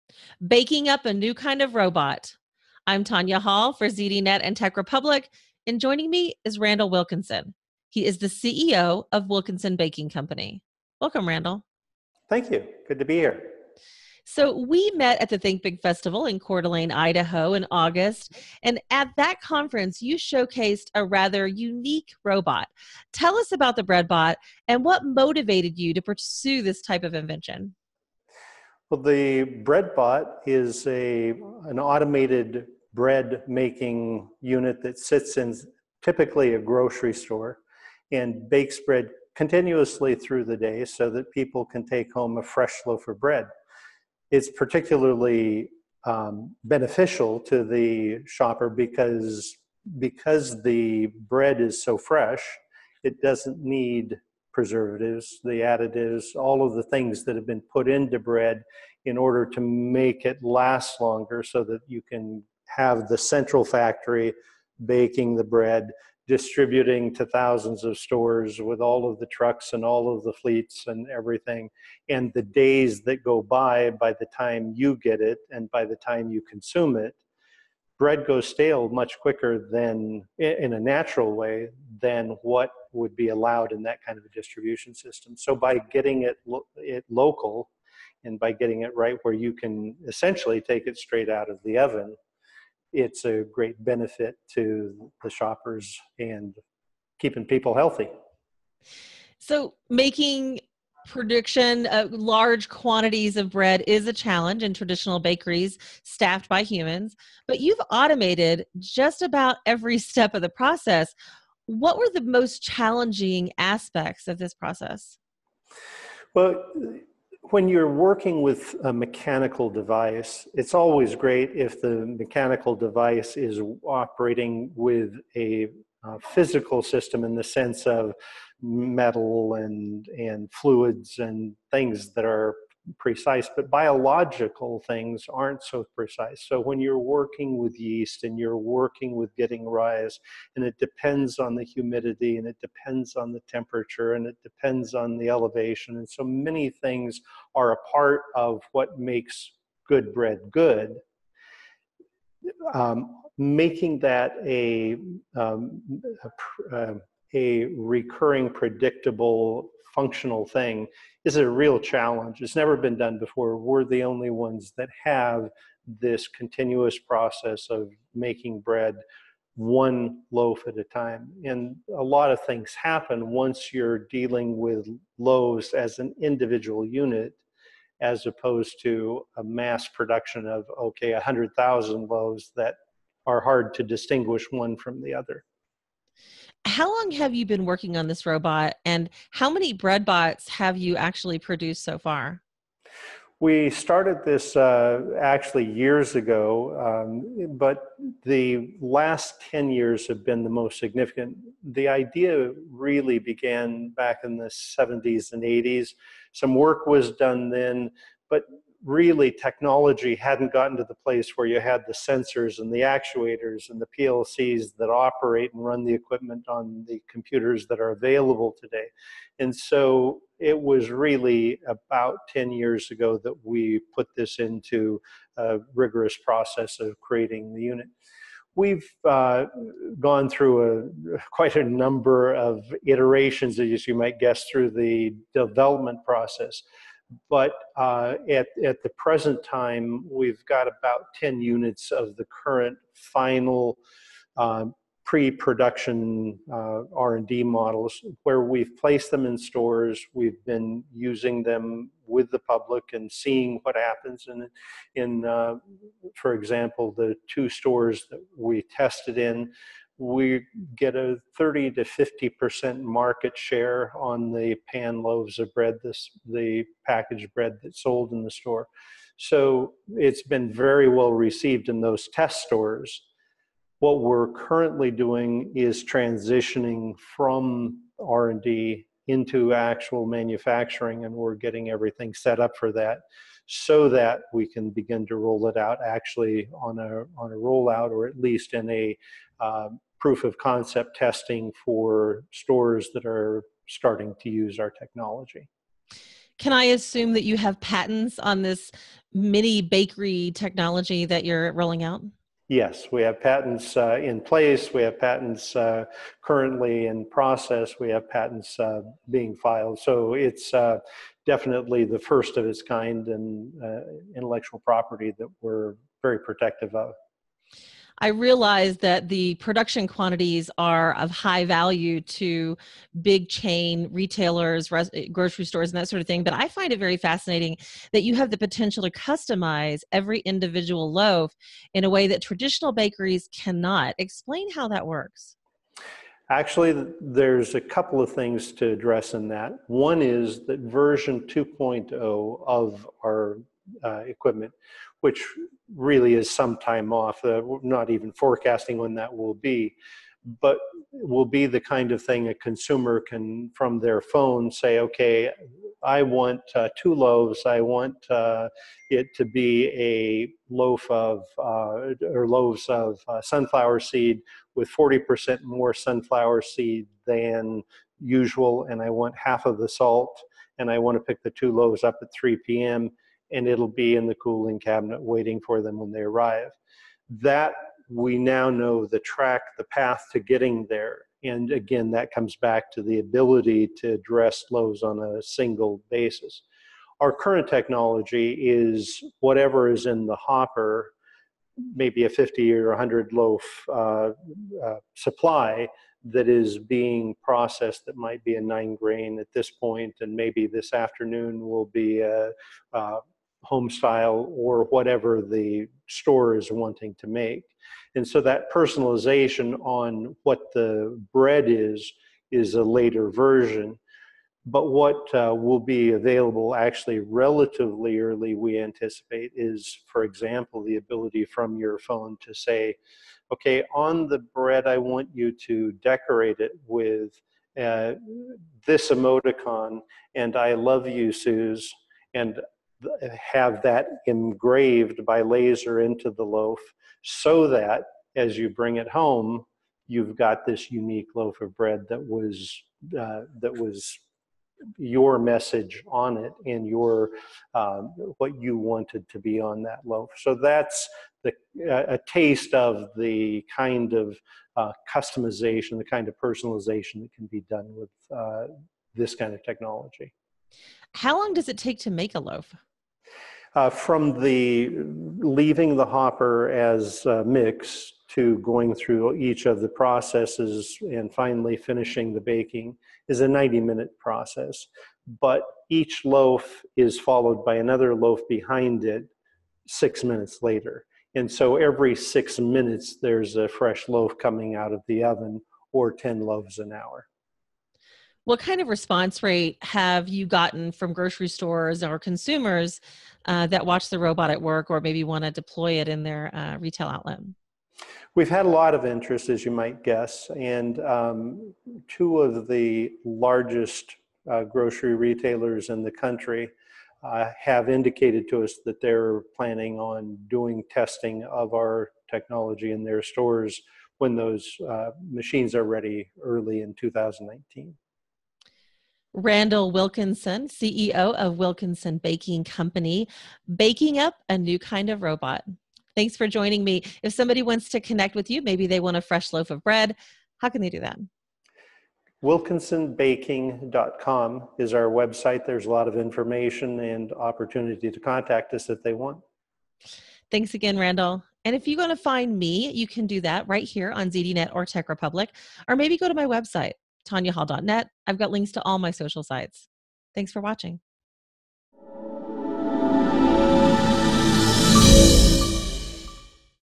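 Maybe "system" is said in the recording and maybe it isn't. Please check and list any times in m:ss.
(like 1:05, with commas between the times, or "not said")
1:24, 2:06.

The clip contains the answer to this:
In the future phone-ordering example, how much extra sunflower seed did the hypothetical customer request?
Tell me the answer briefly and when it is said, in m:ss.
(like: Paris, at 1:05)
40%, at 6:04.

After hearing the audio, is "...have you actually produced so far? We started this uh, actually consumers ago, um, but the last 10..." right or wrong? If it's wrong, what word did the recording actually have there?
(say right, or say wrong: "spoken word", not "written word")
wrong: "years", not "consumers".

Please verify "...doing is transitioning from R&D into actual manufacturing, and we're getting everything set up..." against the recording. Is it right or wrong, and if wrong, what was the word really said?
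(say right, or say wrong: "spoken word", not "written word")
right.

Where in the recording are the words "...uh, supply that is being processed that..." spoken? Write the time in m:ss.
6:34.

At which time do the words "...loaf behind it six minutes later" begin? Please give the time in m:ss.
7:57.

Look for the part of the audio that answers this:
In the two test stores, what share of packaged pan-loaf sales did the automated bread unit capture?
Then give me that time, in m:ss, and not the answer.
4:21.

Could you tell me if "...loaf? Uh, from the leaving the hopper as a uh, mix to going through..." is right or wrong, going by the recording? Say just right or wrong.
right.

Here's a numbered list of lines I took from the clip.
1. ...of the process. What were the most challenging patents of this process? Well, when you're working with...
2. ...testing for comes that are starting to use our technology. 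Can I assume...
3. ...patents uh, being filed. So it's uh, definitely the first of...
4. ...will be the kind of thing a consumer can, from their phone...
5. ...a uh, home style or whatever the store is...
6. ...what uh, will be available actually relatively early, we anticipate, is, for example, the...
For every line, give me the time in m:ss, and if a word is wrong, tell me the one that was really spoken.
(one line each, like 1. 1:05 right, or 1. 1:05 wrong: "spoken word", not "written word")
1. 1:50 wrong: "aspects", not "patents"
2. 4:50 wrong: "stores", not "comes"
3. 5:08 right
4. 5:50 right
5. 6:42 right
6. 6:54 right.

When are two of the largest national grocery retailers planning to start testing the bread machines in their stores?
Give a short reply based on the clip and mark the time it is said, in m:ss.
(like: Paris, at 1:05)
early 2019, at 8:36.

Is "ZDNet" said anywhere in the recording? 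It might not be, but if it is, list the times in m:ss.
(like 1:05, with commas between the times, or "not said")
0:03, 9:04.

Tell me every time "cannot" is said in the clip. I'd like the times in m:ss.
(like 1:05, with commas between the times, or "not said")
5:33.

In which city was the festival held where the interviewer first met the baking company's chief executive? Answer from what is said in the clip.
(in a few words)
Coeur d'Alene, Idaho.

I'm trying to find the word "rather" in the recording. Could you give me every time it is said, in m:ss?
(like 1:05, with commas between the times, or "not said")
0:21.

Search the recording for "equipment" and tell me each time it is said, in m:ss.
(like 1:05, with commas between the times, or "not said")
3:35, 5:44.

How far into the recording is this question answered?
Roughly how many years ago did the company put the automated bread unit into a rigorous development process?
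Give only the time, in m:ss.
3:41.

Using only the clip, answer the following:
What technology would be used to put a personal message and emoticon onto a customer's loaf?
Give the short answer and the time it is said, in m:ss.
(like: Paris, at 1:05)
laser, at 7:15.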